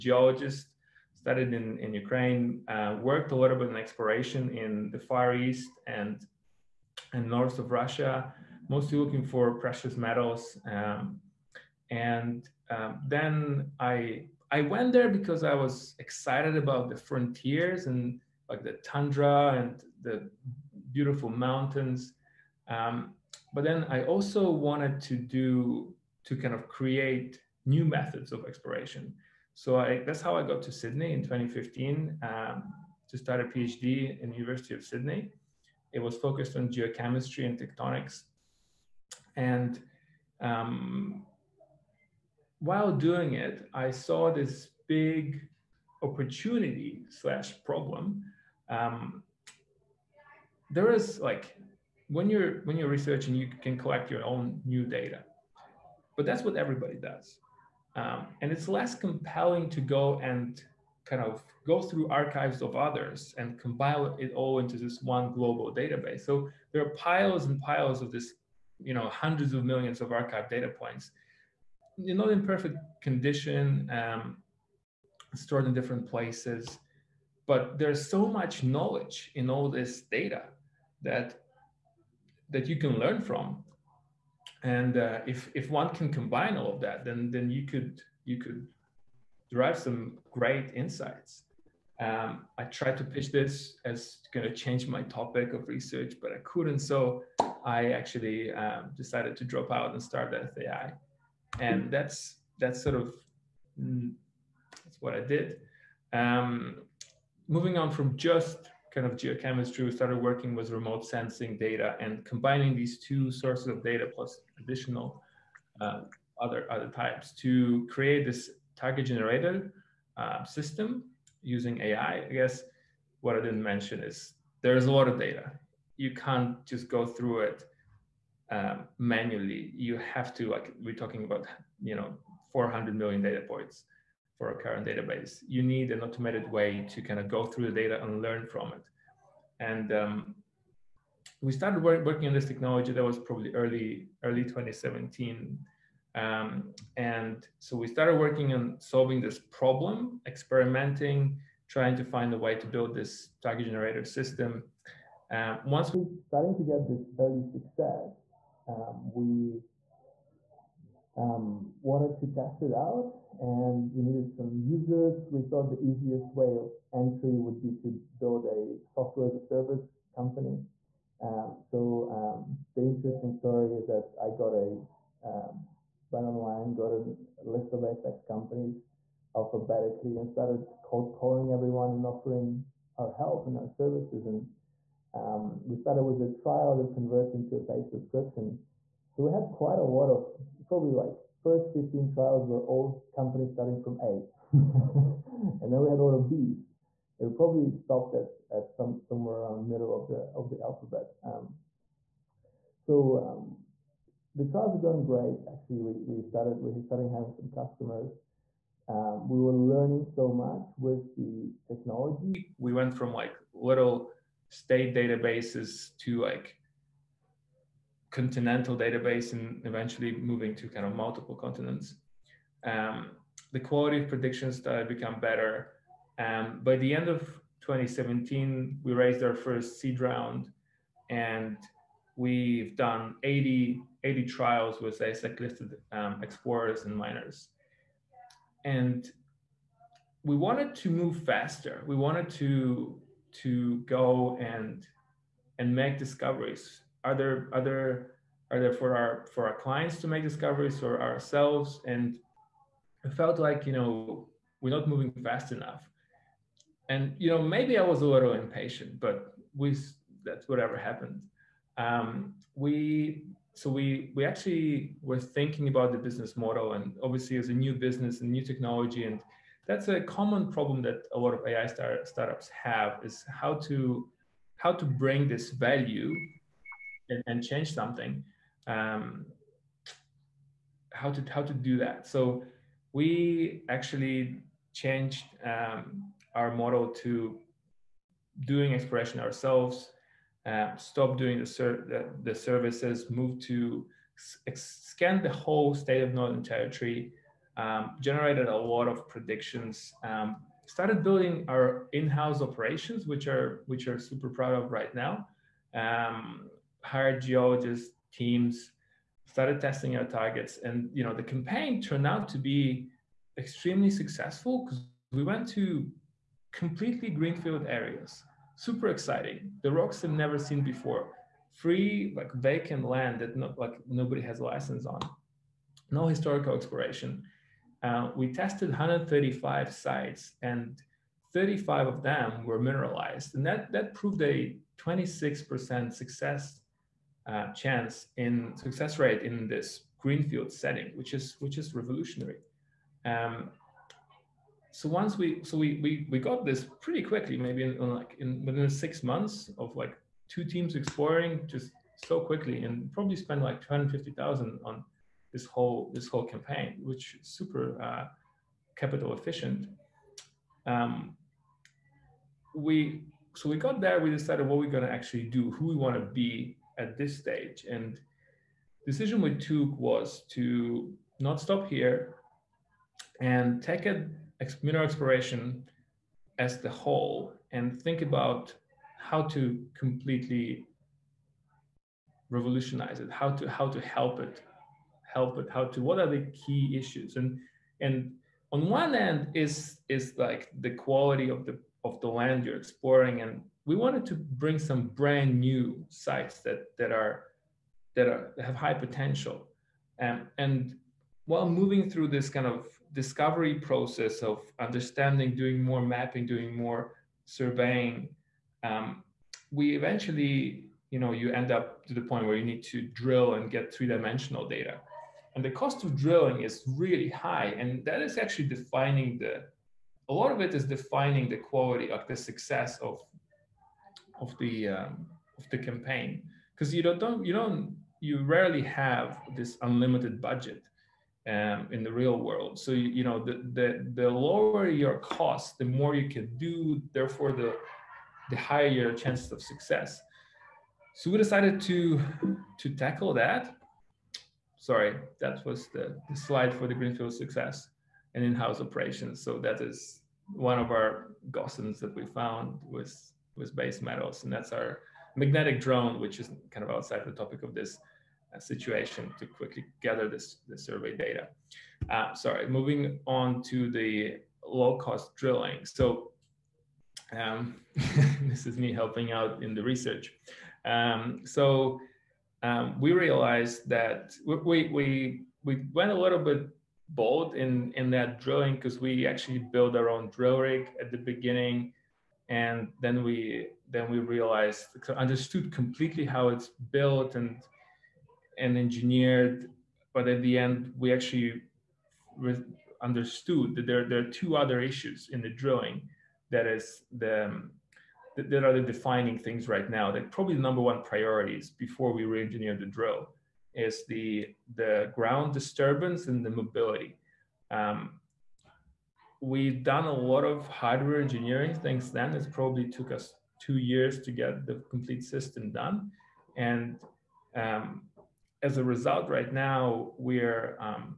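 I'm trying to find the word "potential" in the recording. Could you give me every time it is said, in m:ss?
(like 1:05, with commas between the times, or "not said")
6:38.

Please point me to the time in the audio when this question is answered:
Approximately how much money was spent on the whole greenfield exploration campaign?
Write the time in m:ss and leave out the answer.
5:53.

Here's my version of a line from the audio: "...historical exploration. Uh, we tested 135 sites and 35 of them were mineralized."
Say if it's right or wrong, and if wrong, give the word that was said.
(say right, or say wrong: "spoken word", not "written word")
right.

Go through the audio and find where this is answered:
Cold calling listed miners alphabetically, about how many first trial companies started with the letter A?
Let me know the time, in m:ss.
3:11.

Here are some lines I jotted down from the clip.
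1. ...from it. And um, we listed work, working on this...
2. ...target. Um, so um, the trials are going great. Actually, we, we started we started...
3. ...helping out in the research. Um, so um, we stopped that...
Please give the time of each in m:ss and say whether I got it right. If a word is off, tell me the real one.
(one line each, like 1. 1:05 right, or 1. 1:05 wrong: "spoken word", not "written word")
1. 2:18 wrong: "started", not "listed"
2. 3:20 wrong: "alphabet", not "target"
3. 7:48 wrong: "realized", not "stopped".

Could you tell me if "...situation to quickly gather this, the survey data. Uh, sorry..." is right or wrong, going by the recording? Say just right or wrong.
right.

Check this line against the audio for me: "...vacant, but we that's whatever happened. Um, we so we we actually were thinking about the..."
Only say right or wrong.
wrong.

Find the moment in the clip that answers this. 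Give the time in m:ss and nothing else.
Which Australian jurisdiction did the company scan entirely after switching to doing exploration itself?
4:56.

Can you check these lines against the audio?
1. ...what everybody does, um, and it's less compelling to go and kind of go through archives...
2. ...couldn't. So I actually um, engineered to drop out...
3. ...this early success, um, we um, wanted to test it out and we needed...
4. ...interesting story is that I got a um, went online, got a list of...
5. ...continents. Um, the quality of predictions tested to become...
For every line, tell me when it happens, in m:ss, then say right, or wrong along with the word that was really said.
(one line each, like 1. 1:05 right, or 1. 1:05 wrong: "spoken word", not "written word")
1. 0:56 right
2. 1:36 wrong: "decided", not "engineered"
3. 2:36 right
4. 2:52 right
5. 3:41 wrong: "started", not "tested".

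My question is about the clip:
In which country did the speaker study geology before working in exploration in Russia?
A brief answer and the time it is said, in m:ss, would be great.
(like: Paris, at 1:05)
Ukraine, at 0:01.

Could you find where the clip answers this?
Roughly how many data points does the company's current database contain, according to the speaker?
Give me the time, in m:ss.
2:12.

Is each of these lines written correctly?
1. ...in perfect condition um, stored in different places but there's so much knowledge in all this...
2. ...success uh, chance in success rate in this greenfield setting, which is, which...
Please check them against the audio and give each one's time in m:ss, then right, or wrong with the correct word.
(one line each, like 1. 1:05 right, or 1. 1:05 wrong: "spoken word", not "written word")
1. 1:12 right
2. 5:35 right.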